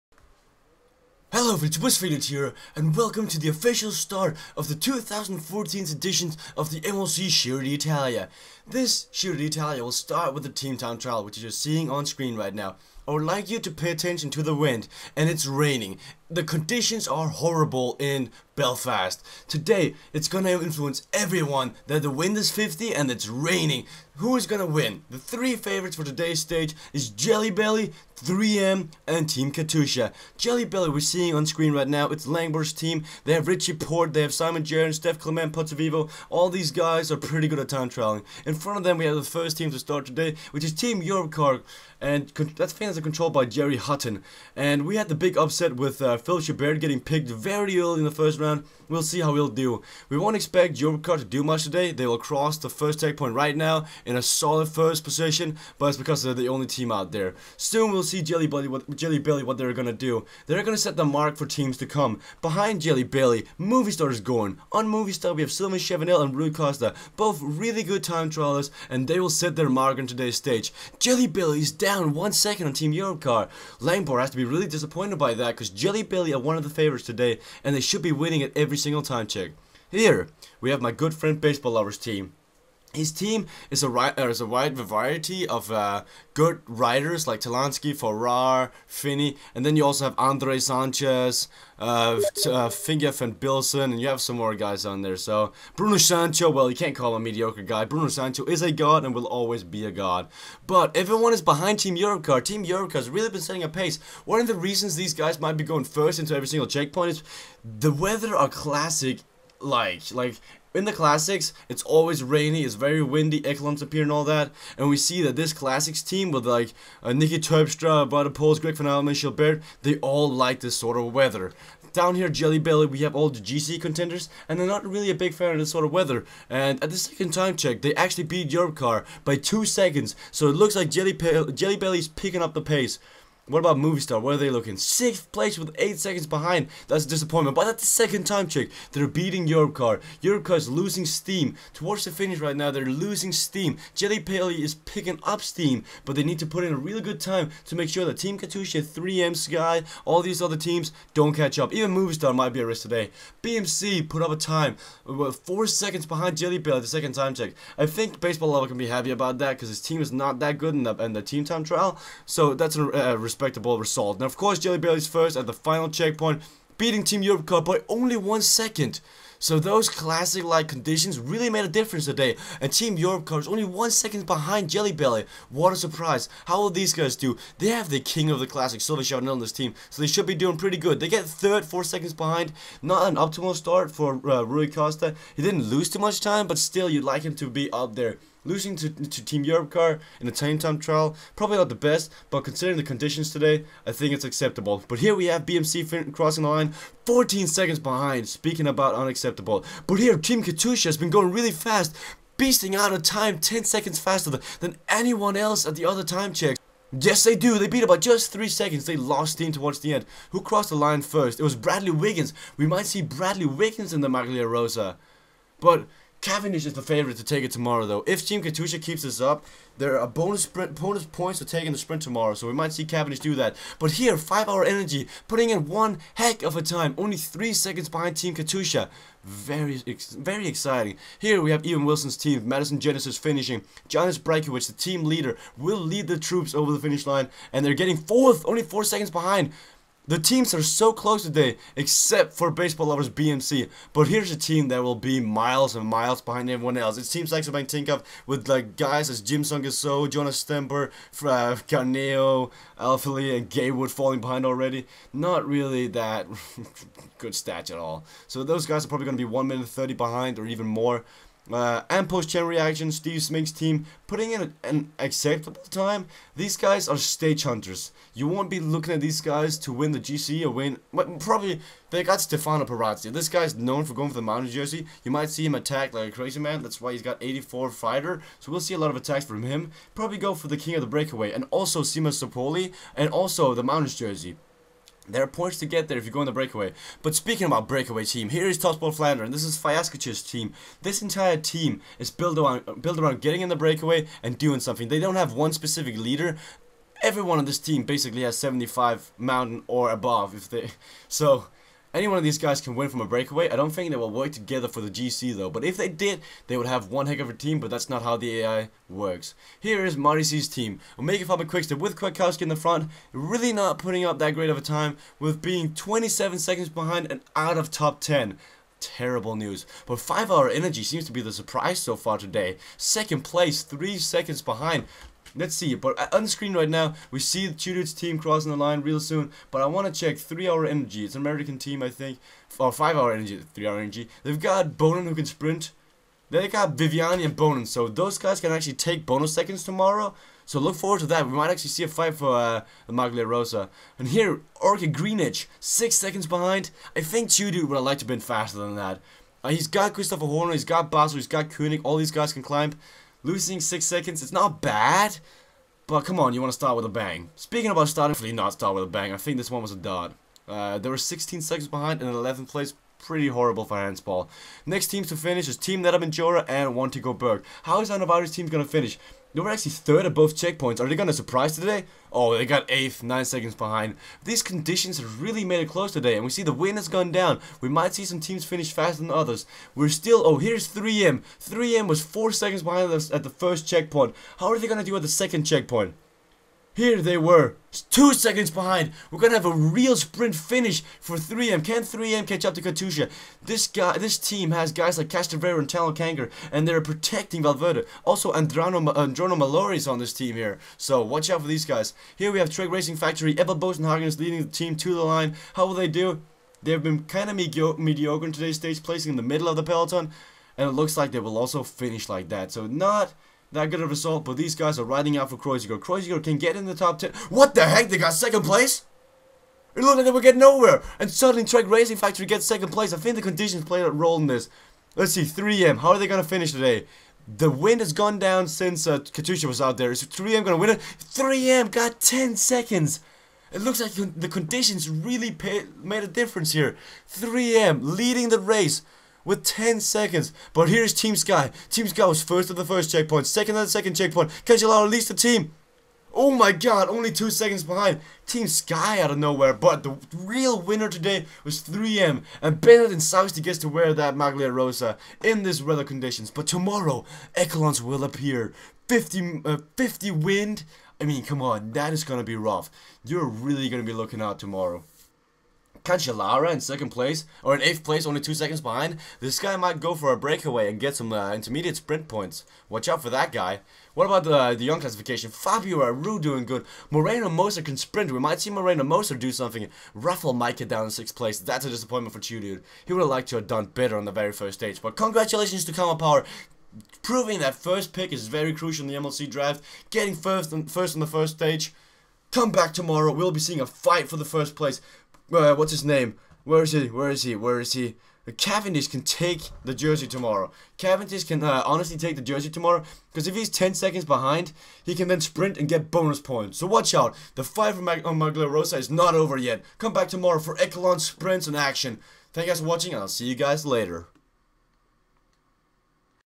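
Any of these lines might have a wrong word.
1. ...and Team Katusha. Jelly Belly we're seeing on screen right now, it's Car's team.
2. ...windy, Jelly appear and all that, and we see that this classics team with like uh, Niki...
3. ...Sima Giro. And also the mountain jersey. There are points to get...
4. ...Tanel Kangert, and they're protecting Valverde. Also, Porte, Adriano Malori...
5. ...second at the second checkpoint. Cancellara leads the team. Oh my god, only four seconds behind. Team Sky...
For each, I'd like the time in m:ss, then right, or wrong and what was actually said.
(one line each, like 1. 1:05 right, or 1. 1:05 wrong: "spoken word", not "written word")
1. 0:29 wrong: "Langbor", not "Car"
2. 1:53 wrong: "Echelons", not "Jelly"
3. 4:41 wrong: "Sapoli", not "Giro"
4. 6:35 wrong: "Adriano", not "Porte"
5. 7:23 wrong: "two", not "four".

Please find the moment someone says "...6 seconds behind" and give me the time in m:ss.
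5:45.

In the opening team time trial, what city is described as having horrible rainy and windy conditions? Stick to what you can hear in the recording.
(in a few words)
Belfast.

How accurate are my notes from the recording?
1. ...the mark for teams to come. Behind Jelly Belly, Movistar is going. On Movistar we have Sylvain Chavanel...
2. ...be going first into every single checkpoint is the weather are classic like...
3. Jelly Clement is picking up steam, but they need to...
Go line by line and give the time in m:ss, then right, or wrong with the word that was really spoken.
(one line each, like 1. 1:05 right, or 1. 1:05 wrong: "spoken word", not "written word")
1. 1:00 right
2. 1:45 right
3. 2:23 wrong: "Paley", not "Clement".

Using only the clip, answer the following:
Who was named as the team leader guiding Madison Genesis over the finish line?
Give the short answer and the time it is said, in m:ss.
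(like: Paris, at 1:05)
Jonas Brajkovic, at 3:53.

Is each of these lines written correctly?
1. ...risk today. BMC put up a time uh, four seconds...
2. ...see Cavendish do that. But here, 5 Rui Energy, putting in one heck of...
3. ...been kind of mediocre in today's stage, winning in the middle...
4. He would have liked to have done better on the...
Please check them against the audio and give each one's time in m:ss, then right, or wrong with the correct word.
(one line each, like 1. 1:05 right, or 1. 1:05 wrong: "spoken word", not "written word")
1. 2:32 right
2. 3:42 wrong: "Hour", not "Rui"
3. 6:46 wrong: "placing", not "winning"
4. 8:02 right.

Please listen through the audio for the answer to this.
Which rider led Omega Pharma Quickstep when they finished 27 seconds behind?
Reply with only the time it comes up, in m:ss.
5:11.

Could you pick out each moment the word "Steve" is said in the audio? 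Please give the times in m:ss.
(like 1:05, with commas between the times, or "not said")
4:22.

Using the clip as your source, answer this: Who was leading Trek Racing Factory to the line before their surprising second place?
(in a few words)
Eva Bosenhagen.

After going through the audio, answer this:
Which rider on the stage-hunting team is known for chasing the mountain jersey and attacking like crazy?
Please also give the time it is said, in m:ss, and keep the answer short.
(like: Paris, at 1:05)
Stefano Pirazzi, at 4:32.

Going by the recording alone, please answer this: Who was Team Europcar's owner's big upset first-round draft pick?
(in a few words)
Phil Chabert.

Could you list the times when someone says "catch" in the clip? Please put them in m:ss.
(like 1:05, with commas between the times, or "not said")
2:31, 6:32.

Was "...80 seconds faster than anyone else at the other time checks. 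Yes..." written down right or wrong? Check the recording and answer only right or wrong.
wrong.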